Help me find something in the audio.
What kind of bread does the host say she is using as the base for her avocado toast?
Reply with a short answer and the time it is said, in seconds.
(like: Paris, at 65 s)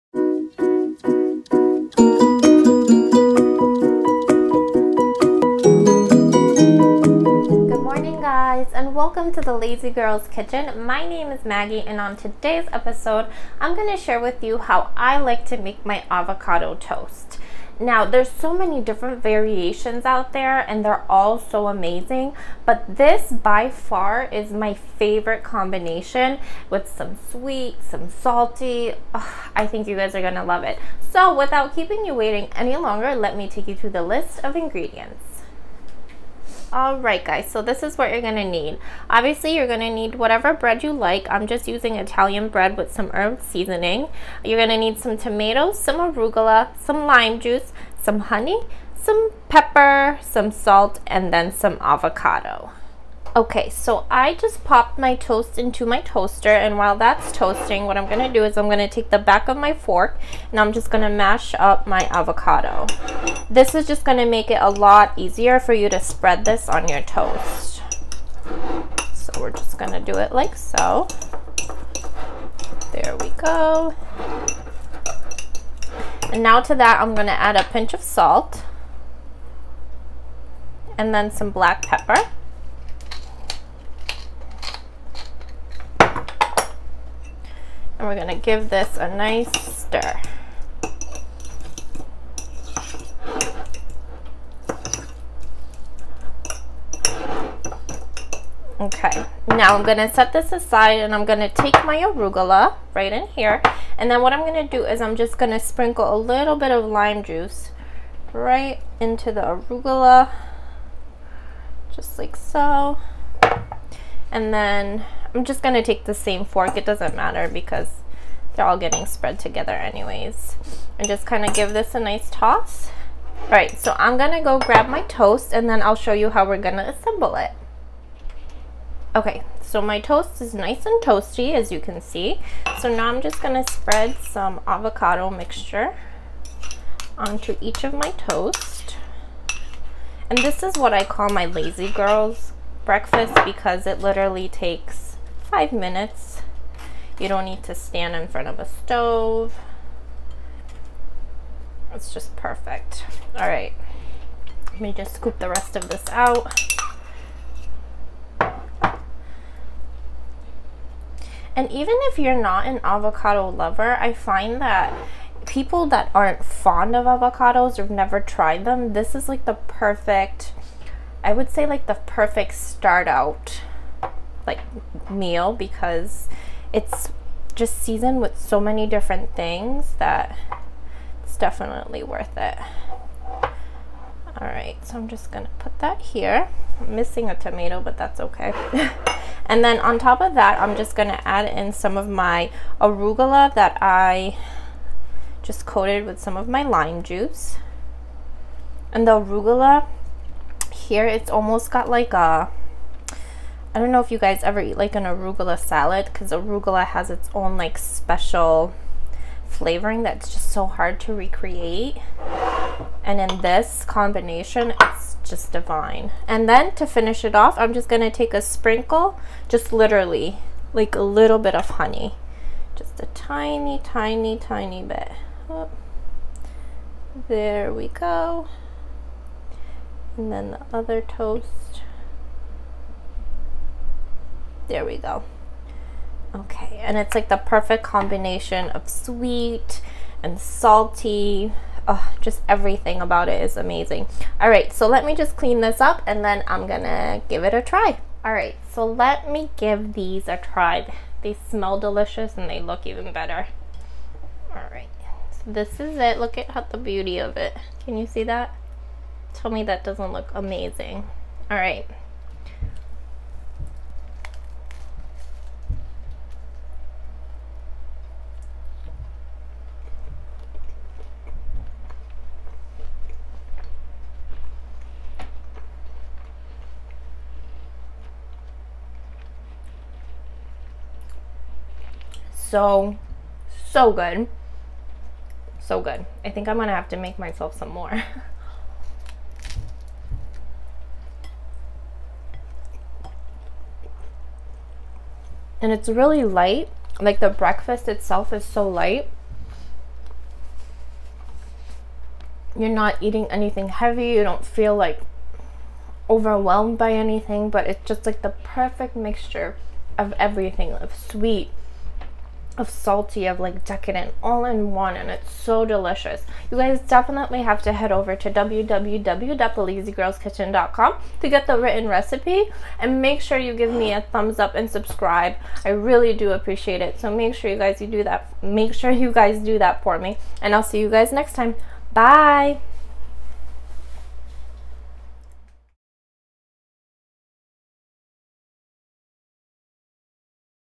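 Italian bread, at 41 s.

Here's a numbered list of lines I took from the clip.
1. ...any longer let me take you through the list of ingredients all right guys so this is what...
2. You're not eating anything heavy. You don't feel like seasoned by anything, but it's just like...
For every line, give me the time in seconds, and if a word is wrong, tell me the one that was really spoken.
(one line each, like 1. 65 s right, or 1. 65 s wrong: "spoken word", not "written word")
1. 32 s right
2. 302 s wrong: "overwhelmed", not "seasoned".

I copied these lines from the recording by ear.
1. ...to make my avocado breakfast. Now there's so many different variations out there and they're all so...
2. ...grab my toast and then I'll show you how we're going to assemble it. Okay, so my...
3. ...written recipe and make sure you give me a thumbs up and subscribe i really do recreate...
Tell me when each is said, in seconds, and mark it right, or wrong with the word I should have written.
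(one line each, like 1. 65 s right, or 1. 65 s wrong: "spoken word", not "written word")
1. 15 s wrong: "toast", not "breakfast"
2. 124 s right
3. 321 s wrong: "appreciate", not "recreate".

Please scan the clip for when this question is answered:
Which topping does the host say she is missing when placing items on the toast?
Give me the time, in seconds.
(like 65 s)
187 s.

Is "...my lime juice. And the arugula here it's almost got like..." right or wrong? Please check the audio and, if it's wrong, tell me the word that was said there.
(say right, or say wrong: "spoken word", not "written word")
right.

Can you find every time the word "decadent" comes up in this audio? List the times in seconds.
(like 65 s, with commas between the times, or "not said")
313 s.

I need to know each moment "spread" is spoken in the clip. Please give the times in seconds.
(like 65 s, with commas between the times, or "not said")
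66 s, 119 s, 133 s.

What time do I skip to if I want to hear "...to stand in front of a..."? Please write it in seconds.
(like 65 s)
147 s.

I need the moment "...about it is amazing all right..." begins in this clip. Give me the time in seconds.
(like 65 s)
243 s.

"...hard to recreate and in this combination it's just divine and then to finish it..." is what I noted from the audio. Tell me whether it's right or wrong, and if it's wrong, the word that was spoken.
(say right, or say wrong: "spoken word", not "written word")
right.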